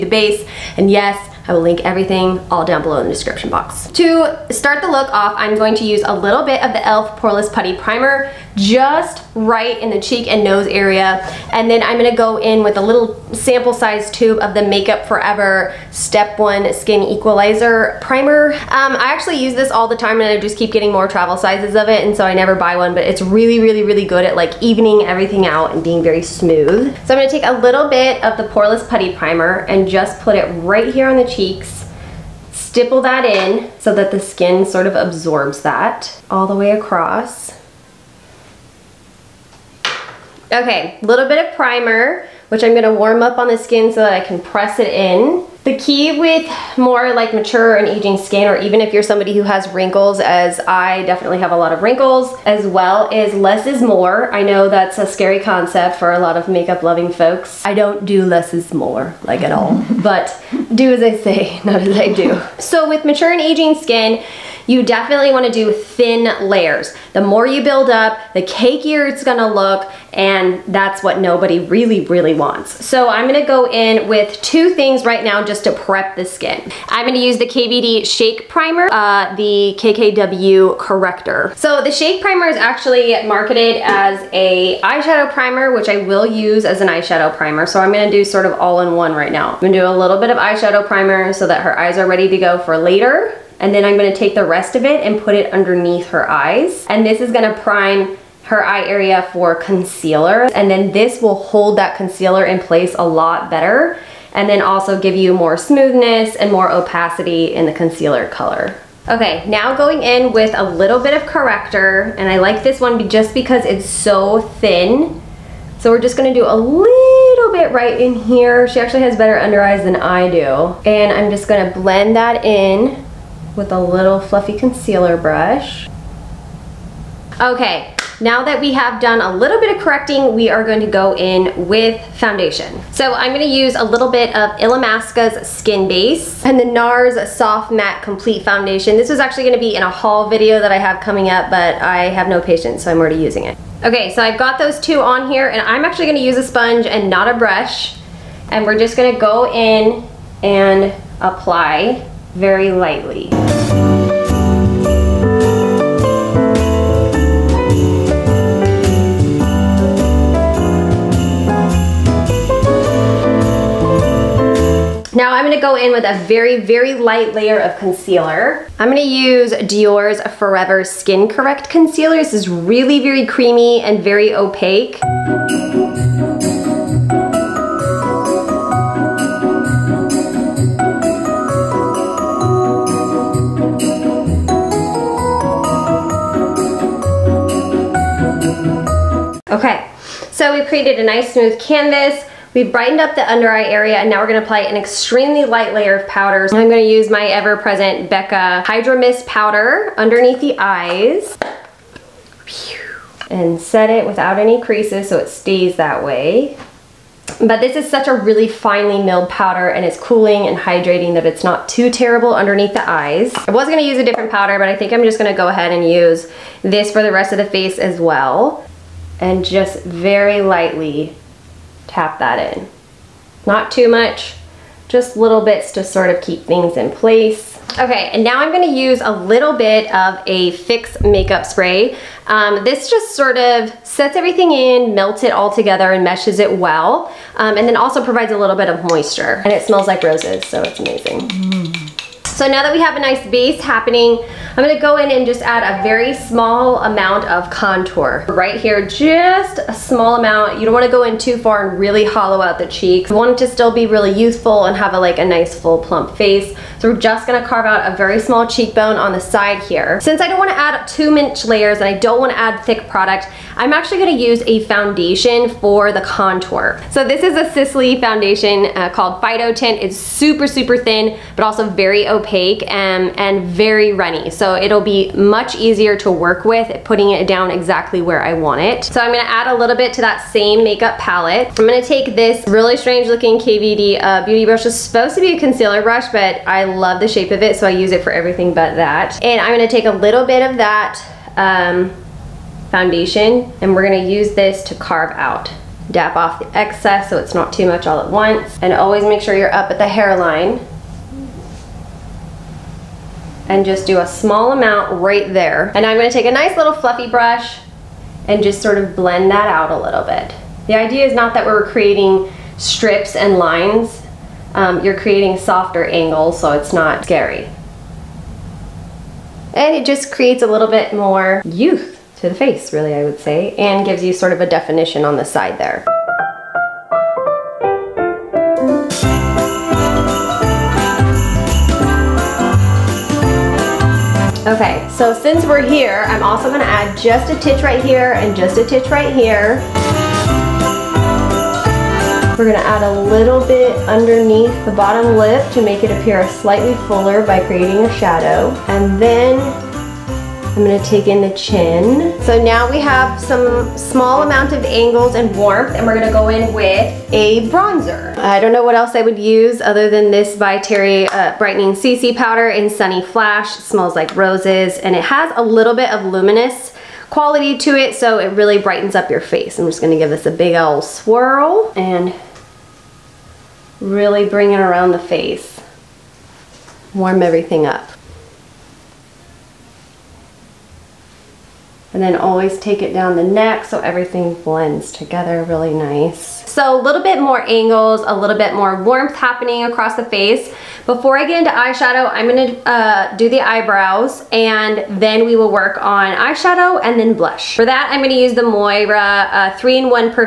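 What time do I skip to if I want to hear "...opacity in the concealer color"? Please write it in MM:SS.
01:46.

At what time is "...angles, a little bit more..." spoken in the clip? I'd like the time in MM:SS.
06:27.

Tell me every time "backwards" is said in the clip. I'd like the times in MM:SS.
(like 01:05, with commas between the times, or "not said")
not said.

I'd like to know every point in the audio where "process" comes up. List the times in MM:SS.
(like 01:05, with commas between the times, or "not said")
not said.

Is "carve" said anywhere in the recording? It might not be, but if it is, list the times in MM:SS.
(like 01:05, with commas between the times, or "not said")
04:17, 04:54.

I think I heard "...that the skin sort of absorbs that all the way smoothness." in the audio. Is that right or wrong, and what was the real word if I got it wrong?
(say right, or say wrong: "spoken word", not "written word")
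wrong: "across", not "smoothness".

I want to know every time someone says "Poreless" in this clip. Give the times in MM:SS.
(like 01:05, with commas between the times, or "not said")
00:07, 00:28.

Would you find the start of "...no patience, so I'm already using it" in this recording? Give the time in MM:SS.
02:22.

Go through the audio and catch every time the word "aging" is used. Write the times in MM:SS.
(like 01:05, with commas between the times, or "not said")
00:47, 01:03.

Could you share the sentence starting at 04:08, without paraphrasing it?
Right here, just a small amount.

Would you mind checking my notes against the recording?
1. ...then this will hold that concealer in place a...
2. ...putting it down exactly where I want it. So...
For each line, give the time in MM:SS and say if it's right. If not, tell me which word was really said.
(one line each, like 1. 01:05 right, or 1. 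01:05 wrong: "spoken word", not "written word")
1. 01:40 right
2. 04:36 right.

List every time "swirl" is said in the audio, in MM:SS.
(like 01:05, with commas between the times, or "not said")
06:10.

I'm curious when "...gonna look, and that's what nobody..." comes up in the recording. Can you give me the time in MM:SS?
01:09.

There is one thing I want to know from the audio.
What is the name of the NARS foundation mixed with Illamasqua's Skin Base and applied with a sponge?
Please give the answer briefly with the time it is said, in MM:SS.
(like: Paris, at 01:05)
Soft Matte Complete Foundation, at 02:17.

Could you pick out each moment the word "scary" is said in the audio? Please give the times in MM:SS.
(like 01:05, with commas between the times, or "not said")
00:55, 05:17.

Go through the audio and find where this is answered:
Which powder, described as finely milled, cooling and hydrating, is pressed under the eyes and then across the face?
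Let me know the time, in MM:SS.
03:18.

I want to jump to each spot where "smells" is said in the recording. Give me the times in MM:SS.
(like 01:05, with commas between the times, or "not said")
03:59, 06:03.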